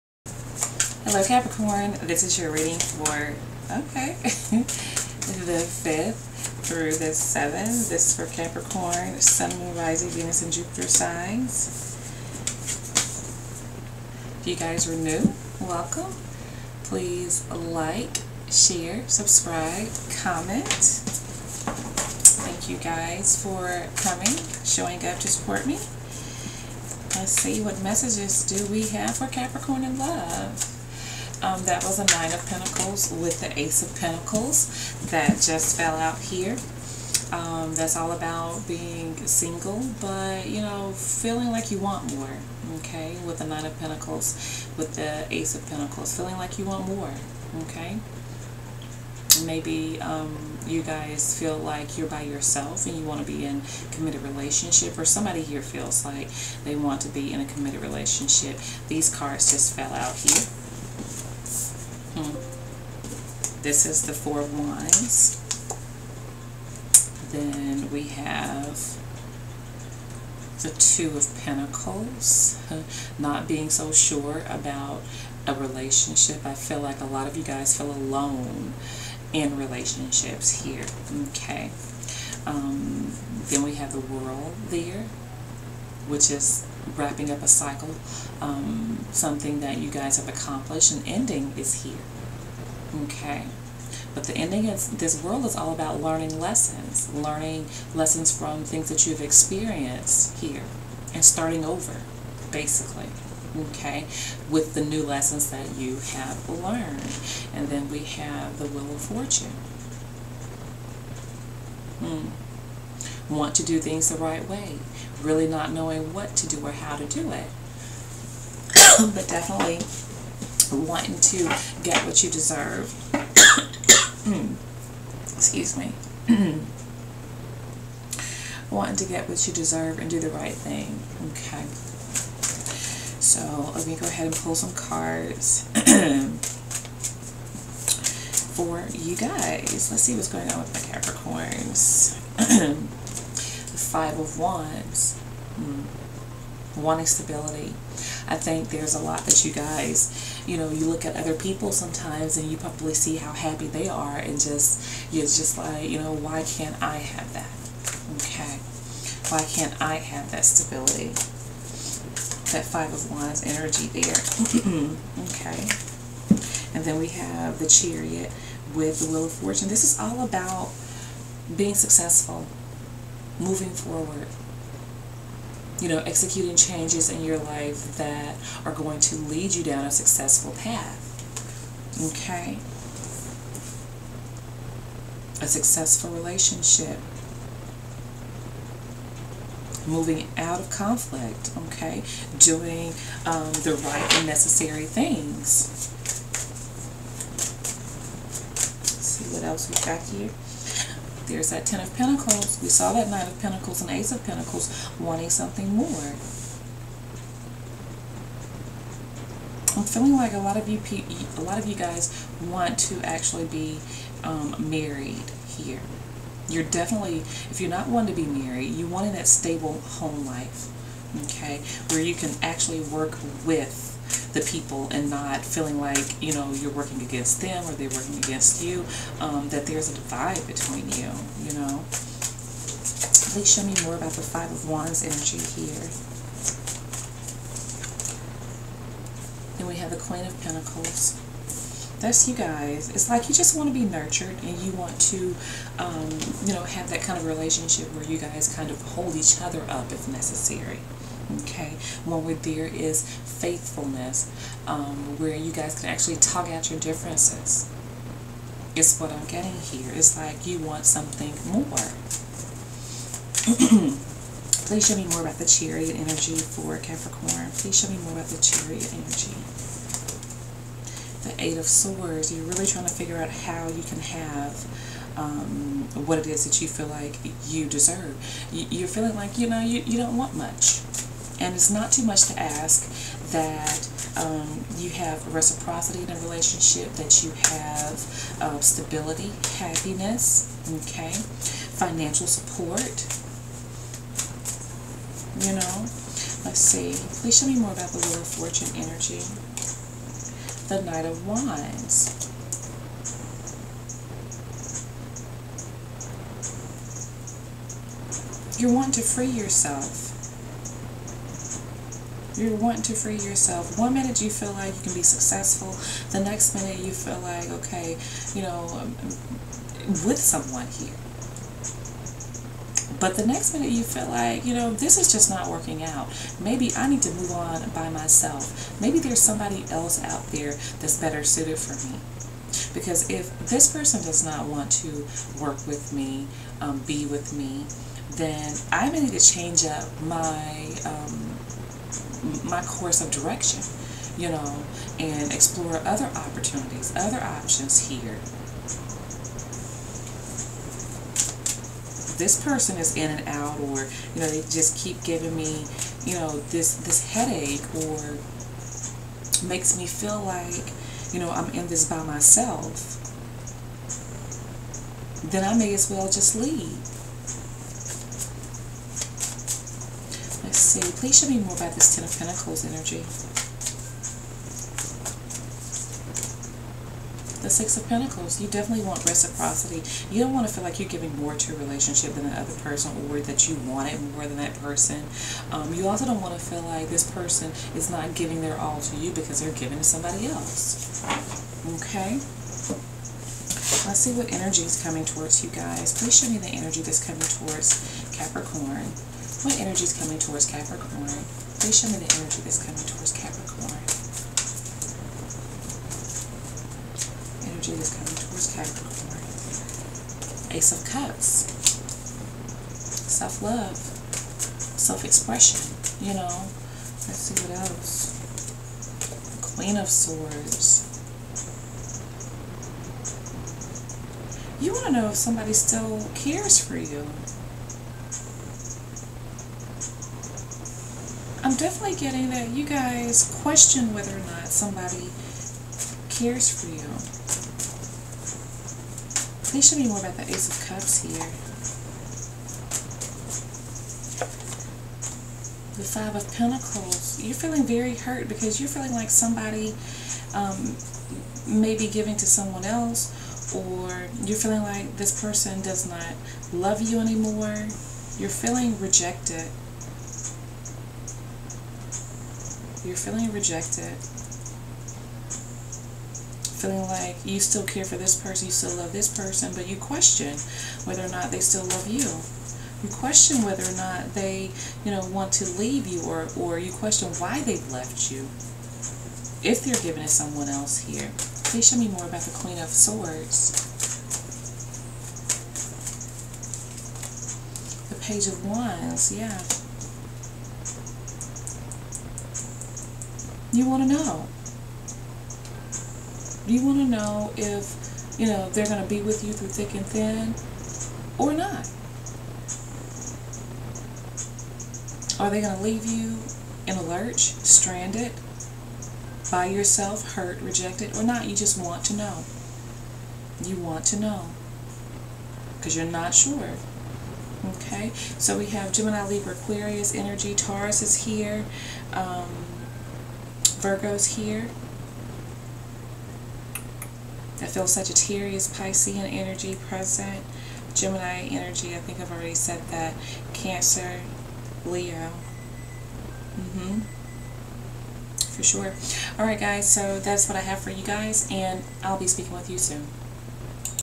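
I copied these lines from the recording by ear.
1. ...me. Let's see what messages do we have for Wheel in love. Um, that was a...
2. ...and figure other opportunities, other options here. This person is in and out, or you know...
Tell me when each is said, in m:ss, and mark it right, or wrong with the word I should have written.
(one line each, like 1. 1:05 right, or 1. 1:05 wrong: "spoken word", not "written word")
1. 0:25 wrong: "Capricorn", not "Wheel"
2. 5:44 wrong: "explore", not "figure".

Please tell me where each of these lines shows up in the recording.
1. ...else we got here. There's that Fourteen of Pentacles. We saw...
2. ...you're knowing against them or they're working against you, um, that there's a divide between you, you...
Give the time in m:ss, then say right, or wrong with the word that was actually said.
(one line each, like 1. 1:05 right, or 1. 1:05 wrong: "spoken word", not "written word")
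1. 3:19 wrong: "Ten", not "Fourteen"
2. 3:46 wrong: "working", not "knowing".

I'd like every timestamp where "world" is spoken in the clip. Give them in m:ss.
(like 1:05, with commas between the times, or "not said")
1:23, 1:35.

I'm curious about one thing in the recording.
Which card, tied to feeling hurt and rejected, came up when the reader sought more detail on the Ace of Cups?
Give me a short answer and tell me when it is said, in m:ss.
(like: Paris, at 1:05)
Five of Pentacles, at 7:25.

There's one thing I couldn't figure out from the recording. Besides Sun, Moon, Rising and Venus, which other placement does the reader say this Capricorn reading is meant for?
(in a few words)
Jupiter.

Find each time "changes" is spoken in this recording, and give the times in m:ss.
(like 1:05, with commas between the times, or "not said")
2:56, 5:39.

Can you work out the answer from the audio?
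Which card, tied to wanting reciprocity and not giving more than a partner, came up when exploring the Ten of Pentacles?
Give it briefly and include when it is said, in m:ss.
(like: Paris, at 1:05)
Six of Pentacles, at 6:17.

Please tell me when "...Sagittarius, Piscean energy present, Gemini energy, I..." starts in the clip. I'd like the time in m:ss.
8:47.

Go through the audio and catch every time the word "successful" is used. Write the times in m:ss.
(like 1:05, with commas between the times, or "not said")
2:51, 2:59, 3:05, 5:15.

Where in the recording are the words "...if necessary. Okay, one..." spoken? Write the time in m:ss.
4:09.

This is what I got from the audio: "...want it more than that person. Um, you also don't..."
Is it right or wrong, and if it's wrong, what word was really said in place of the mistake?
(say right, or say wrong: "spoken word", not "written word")
right.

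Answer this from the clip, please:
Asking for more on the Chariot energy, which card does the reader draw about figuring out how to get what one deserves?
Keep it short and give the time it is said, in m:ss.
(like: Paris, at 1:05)
Eight of Swords, at 4:31.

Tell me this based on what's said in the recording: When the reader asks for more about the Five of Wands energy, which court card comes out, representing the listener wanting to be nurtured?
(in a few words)
Queen of Pentacles.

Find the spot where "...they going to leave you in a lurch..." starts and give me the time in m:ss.
8:25.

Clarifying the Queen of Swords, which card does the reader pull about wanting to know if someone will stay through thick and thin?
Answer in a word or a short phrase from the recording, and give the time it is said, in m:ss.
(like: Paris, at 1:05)
Page of Wands, at 8:07.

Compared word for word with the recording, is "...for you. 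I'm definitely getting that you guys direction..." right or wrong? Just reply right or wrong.
wrong.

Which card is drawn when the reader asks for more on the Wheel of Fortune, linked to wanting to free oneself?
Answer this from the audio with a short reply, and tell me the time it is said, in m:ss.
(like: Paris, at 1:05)
Knight of Wands, at 5:00.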